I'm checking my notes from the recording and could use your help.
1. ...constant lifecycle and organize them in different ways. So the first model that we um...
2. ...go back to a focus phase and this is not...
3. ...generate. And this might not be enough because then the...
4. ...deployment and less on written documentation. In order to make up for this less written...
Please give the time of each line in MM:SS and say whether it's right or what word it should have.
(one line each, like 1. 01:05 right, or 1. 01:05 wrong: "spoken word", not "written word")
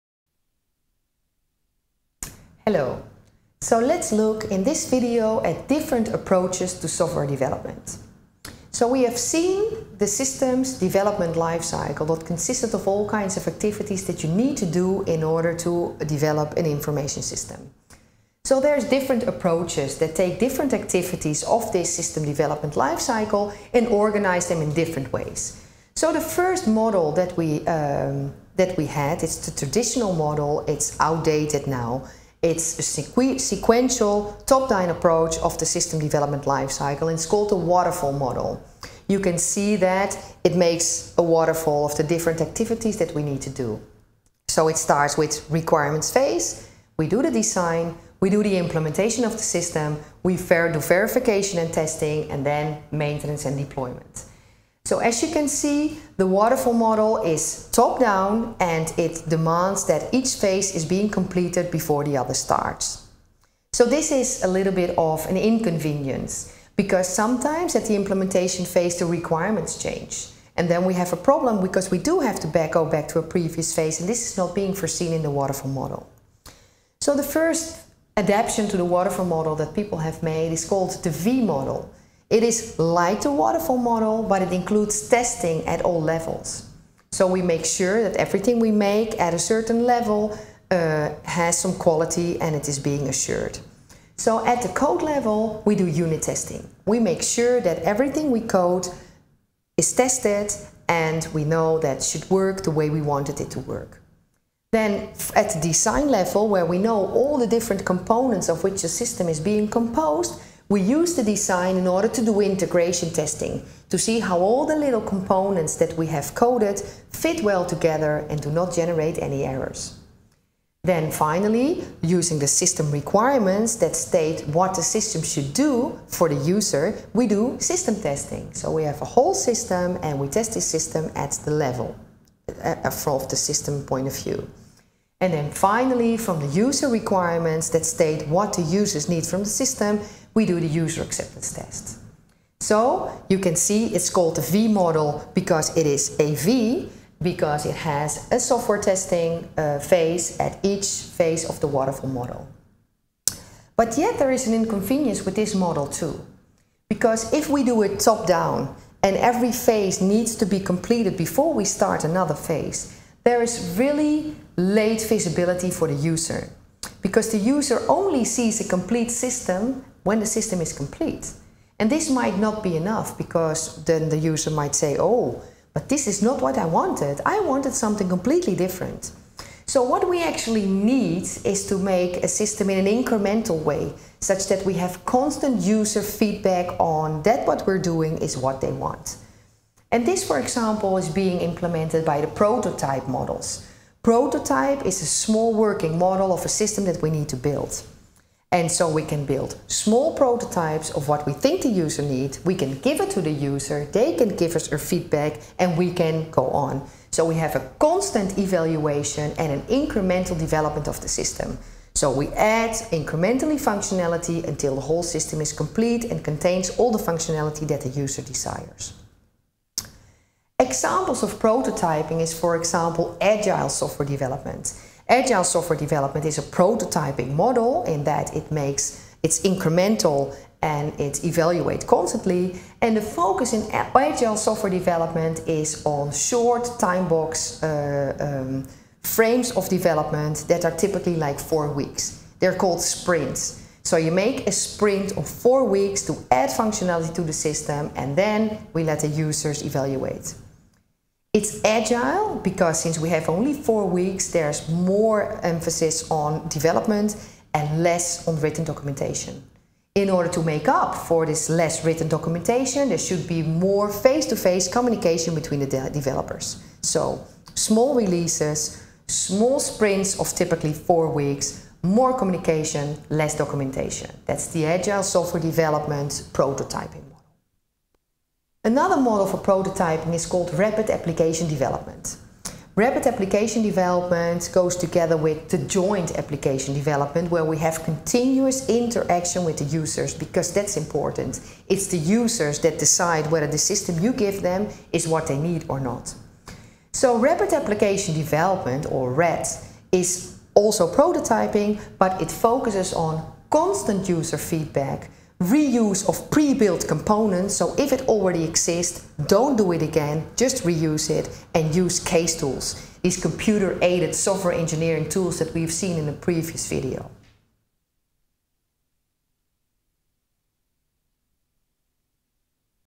1. 00:22 wrong: "development", not "constant"
2. 01:12 wrong: "previous", not "focus"
3. 02:50 wrong: "complete", not "generate"
4. 04:16 wrong: "development", not "deployment".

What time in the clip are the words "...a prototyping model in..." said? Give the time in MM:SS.
03:46.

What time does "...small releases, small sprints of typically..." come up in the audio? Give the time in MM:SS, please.
04:27.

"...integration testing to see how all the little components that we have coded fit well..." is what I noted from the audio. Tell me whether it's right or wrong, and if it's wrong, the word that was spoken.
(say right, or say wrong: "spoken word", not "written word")
right.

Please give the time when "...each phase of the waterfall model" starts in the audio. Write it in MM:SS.
02:30.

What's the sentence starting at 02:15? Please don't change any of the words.
And then finally, from the user requirements that state what the users need from the system, we do the user acceptance test.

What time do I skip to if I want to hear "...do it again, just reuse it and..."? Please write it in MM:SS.
05:09.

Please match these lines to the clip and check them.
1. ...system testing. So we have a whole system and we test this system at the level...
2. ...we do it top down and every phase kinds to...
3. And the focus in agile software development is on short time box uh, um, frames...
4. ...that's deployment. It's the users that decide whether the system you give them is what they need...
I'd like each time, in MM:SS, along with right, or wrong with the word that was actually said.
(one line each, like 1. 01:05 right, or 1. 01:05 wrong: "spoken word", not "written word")
1. 02:07 right
2. 02:37 wrong: "needs", not "kinds"
3. 03:52 right
4. 04:50 wrong: "important", not "deployment".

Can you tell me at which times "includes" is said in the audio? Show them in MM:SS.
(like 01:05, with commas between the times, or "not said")
01:24.